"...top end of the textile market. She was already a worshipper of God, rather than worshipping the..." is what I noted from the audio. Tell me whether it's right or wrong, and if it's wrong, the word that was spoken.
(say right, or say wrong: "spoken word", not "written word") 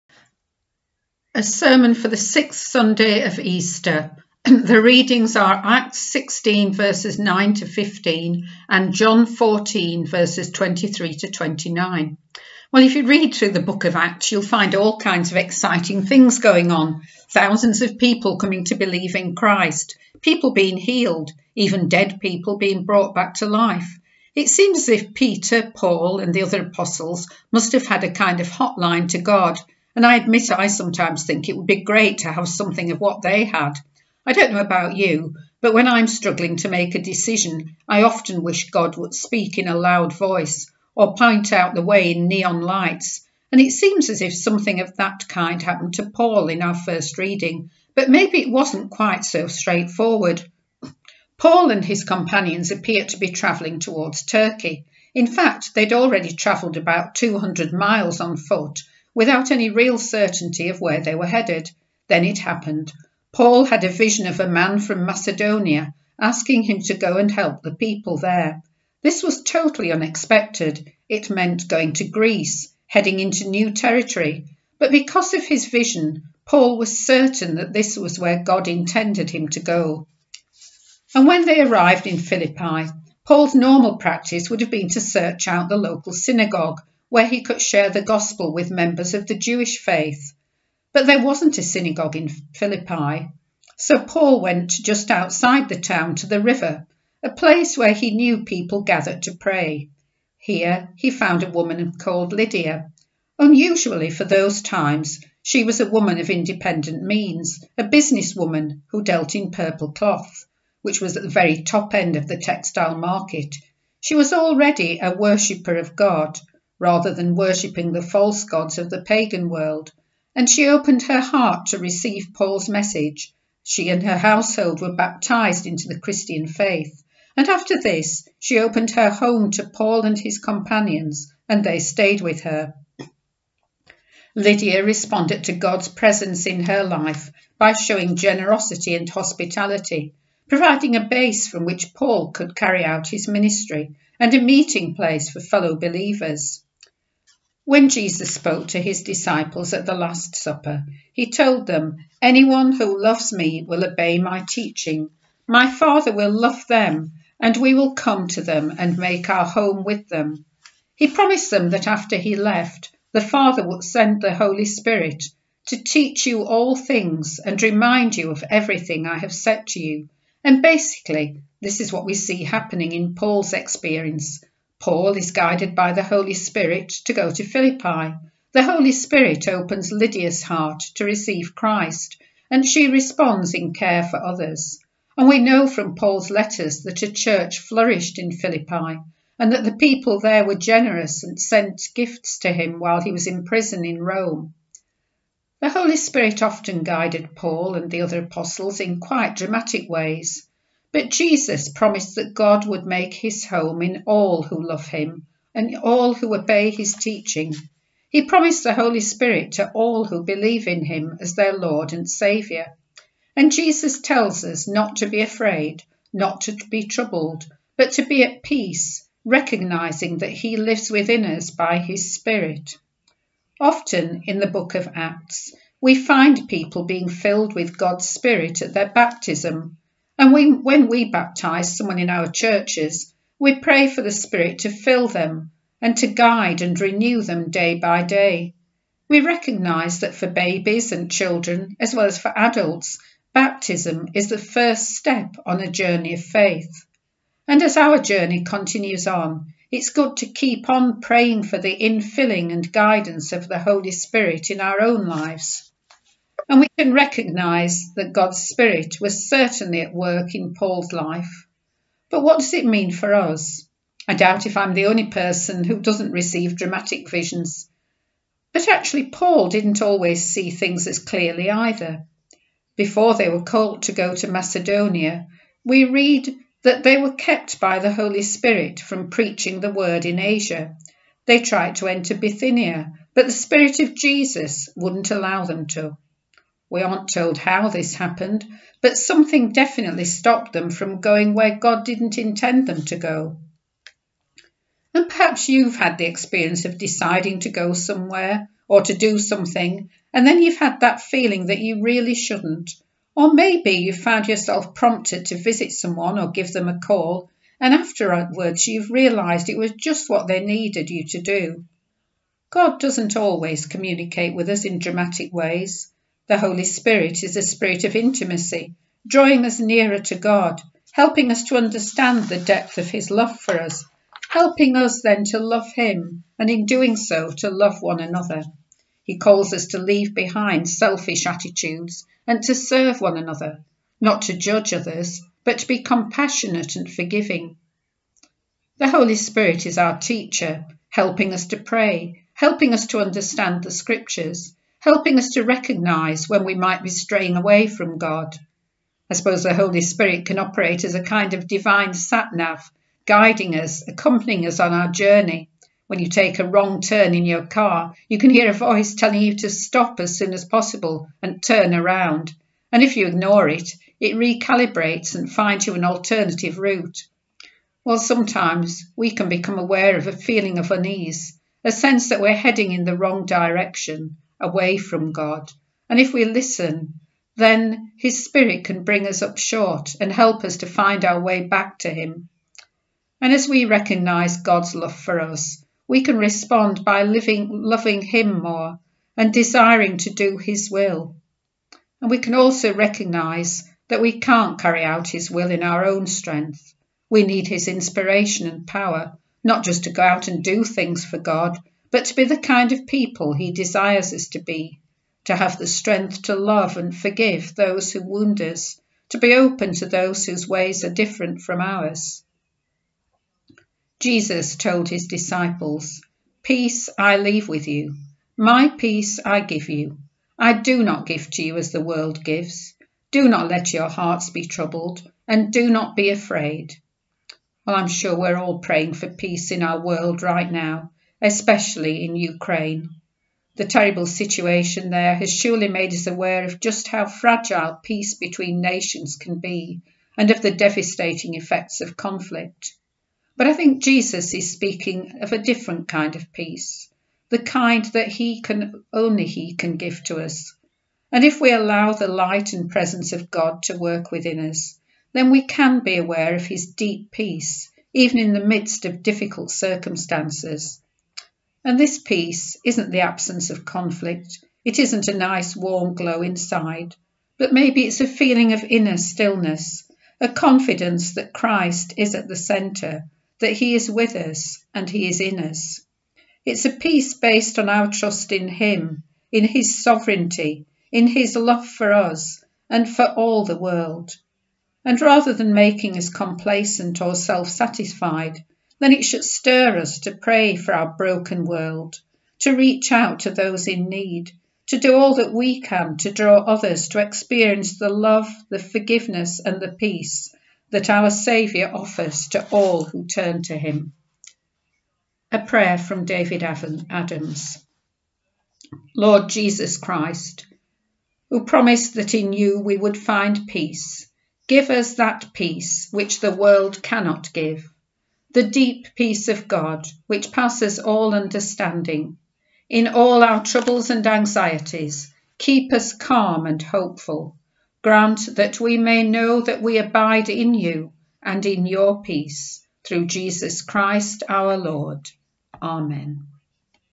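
right.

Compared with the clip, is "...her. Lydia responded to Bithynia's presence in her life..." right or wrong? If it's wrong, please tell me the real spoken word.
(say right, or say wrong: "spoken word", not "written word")
wrong: "God", not "Bithynia".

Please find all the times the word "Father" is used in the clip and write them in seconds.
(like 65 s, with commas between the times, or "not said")
155 s, 163 s.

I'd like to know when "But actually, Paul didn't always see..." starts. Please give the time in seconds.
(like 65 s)
268 s.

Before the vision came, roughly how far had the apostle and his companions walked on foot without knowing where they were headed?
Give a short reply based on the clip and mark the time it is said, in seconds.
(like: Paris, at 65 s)
200 miles, at 57 s.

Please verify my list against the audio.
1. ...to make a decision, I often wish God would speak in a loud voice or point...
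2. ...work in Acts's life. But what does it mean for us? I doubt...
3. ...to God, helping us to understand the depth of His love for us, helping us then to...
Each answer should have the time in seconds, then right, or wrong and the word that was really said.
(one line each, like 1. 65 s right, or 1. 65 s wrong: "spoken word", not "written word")
1. 36 s right
2. 259 s wrong: "Paul", not "Acts"
3. 319 s right.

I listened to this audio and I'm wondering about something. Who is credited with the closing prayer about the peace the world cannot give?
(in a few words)
David Adams.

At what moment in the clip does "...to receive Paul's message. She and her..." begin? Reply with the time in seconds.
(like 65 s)
121 s.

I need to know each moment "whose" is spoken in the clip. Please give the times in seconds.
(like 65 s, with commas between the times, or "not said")
410 s.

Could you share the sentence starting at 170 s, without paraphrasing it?
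And basically, this is what we see happening in Paul's experience Paul is guided by the Holy Spirit to go to Philippi.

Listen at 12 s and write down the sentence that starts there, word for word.
Well, if you read through the book of Acts, you'll find all kinds of exciting things going on.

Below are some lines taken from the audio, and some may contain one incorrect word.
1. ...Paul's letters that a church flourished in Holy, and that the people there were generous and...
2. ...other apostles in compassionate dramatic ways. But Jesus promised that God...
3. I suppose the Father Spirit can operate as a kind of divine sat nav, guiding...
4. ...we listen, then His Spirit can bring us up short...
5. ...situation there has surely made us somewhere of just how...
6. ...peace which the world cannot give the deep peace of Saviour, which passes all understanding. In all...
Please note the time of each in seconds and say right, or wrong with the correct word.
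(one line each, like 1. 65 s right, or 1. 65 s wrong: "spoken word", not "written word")
1. 185 s wrong: "Philippi", not "Holy"
2. 198 s wrong: "quite", not "compassionate"
3. 349 s wrong: "Holy", not "Father"
4. 376 s right
5. 434 s wrong: "aware", not "somewhere"
6. 515 s wrong: "God", not "Saviour".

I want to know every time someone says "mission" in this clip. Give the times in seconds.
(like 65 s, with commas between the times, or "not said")
not said.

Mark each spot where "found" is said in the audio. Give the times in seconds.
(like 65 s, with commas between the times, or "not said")
101 s, 303 s.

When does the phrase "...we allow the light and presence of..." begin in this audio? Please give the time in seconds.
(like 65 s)
451 s.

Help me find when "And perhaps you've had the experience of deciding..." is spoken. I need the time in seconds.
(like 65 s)
294 s.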